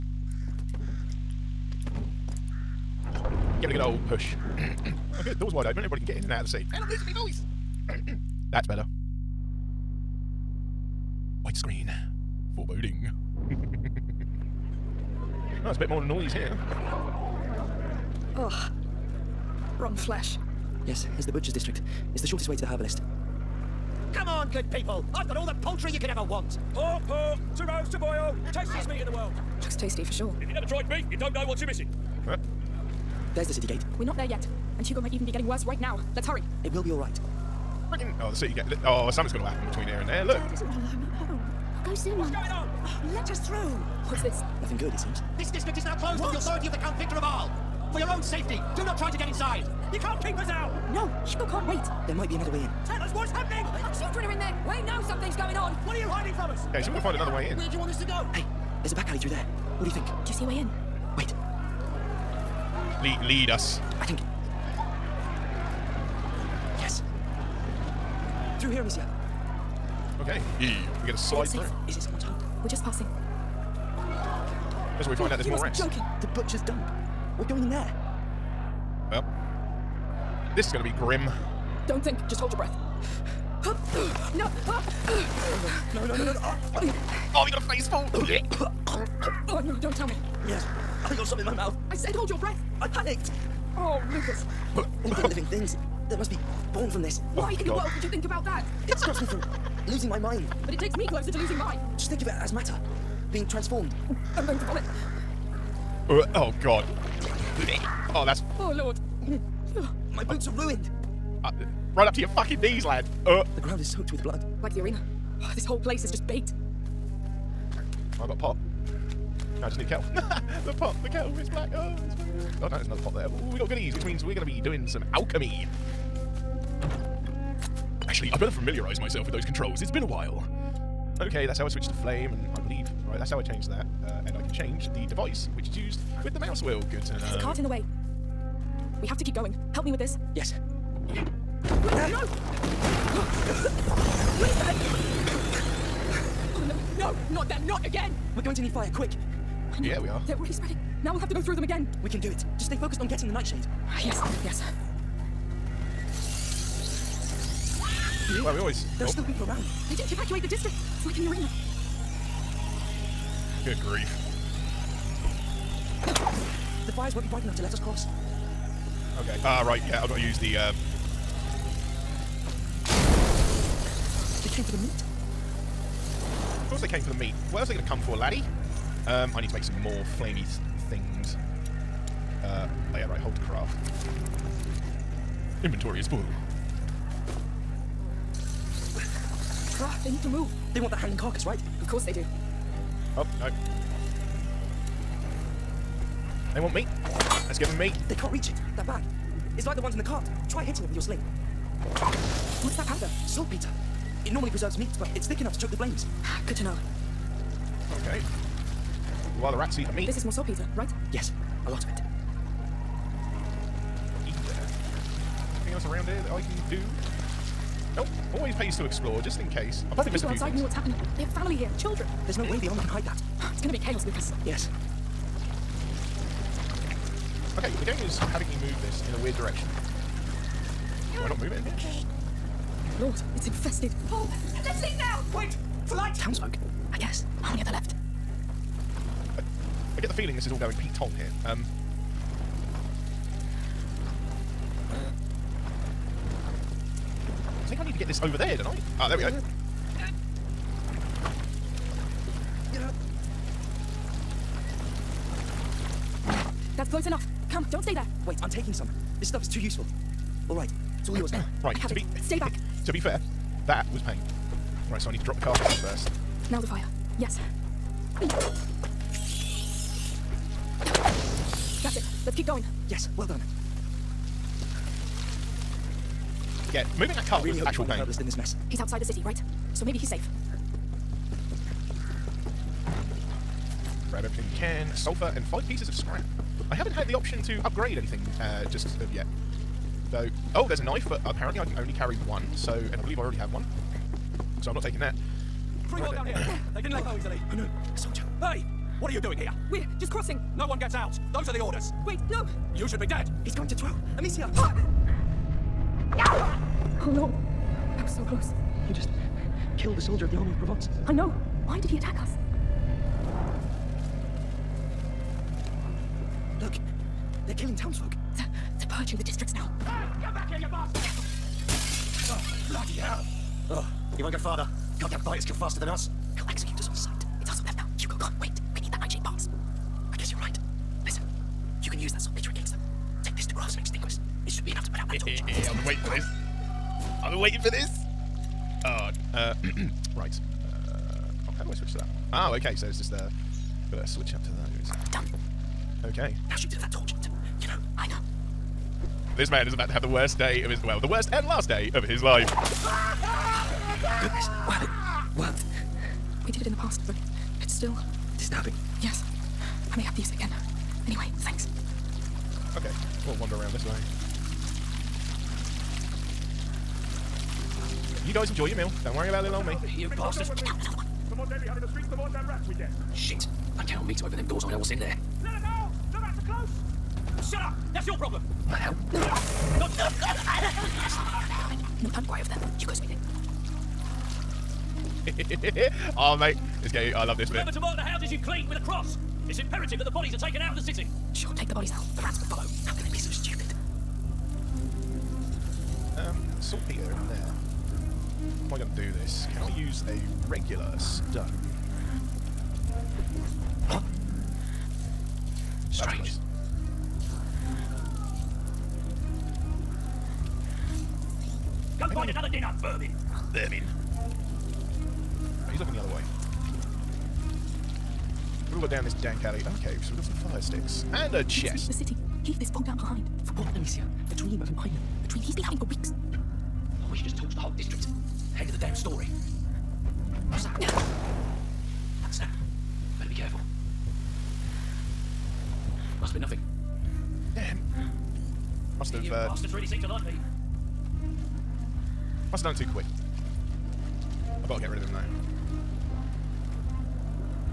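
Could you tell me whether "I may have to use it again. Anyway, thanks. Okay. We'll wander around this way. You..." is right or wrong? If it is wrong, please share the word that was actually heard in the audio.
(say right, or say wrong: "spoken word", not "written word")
right.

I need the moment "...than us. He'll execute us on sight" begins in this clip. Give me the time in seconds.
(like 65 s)
325 s.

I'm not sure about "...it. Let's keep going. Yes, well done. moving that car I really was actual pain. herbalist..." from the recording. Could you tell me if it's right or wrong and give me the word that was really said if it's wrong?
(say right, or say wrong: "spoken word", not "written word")
right.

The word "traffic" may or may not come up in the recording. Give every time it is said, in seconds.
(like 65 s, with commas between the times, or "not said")
not said.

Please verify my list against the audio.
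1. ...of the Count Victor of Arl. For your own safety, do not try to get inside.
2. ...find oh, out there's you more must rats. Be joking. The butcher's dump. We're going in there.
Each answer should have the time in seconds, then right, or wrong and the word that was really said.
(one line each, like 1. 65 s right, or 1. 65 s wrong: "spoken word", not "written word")
1. 46 s right
2. 75 s right.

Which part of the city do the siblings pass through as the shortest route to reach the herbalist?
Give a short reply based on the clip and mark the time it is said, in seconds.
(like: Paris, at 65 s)
Butcher's District, at 21 s.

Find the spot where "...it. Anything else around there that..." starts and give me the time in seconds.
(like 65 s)
211 s.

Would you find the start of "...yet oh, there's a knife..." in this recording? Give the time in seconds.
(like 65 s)
289 s.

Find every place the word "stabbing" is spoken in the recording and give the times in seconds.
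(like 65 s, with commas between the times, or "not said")
358 s.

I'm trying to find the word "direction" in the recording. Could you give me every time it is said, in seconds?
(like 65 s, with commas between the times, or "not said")
229 s.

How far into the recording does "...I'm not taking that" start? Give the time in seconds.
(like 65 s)
294 s.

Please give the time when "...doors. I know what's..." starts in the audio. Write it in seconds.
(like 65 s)
374 s.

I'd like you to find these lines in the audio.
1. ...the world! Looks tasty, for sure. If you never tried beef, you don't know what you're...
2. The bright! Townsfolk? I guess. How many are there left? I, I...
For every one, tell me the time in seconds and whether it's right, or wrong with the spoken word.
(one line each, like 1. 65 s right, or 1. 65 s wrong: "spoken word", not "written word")
1. 29 s right
2. 235 s wrong: "light", not "bright".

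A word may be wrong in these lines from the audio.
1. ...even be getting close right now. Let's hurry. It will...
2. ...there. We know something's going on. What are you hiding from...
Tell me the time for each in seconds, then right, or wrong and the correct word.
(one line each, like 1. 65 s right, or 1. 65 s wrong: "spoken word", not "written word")
1. 35 s wrong: "worse", not "close"
2. 54 s right.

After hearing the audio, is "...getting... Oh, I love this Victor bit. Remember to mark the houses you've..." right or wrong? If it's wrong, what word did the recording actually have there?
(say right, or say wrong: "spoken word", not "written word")
wrong: "Remember", not "Victor".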